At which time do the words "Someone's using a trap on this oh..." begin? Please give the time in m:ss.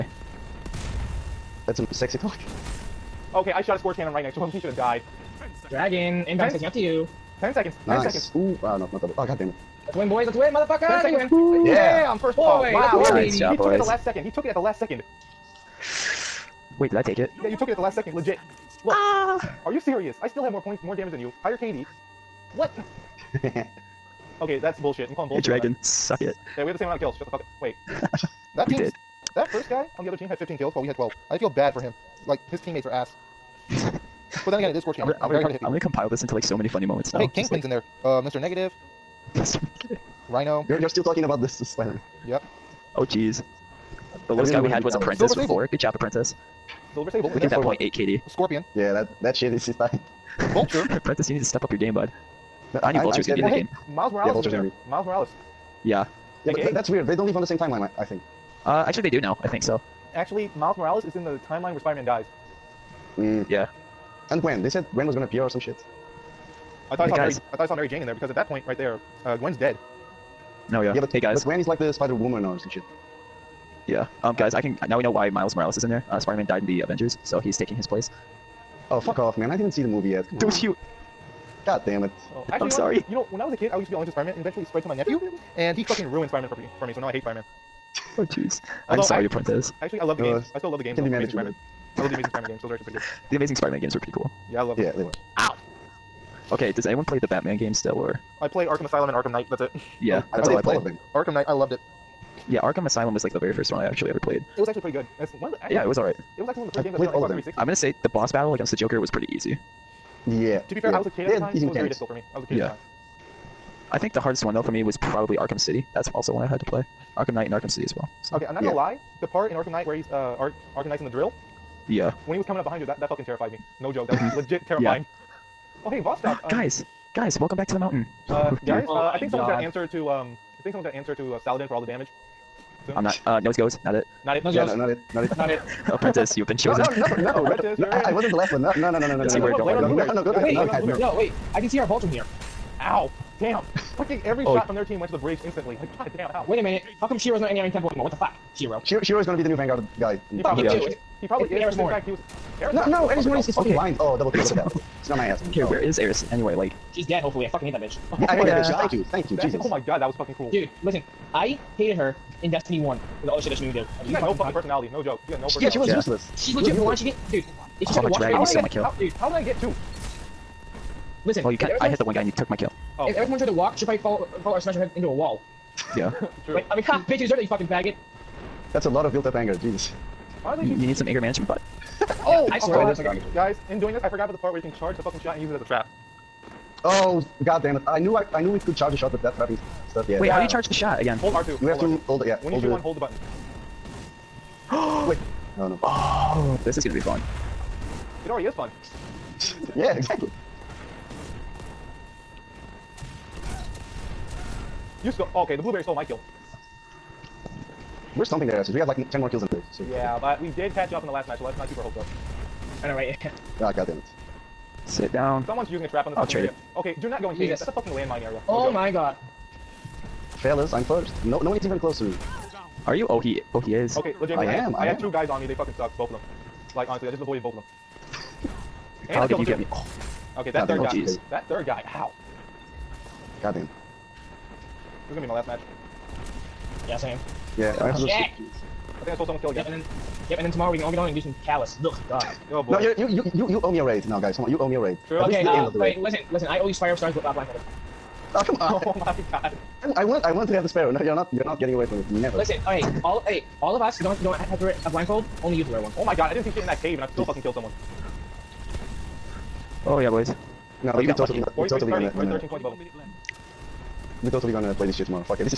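3:35.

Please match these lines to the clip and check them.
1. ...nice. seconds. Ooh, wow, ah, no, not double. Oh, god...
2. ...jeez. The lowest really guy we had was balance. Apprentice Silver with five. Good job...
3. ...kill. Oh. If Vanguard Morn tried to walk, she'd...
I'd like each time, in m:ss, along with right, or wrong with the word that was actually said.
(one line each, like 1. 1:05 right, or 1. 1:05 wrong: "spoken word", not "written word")
1. 0:07 right
2. 0:43 wrong: "four", not "five"
3. 2:52 wrong: "Eris", not "Vanguard".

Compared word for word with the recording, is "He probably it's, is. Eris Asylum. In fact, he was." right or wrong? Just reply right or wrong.
wrong.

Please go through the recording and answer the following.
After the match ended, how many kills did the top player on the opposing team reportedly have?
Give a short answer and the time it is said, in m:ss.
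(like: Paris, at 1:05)
15, at 0:30.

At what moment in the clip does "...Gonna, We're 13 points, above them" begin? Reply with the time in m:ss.
4:21.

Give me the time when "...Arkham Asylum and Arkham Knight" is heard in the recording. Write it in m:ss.
1:38.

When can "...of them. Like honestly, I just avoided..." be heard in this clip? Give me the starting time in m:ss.
3:46.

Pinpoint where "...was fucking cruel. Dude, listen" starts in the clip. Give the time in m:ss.
2:40.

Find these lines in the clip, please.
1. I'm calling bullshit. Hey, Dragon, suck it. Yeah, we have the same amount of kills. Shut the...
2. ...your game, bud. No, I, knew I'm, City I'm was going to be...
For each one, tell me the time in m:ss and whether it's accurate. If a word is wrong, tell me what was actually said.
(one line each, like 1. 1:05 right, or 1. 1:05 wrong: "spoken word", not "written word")
1. 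0:25 right
2. 0:51 wrong: "Vulture", not "City".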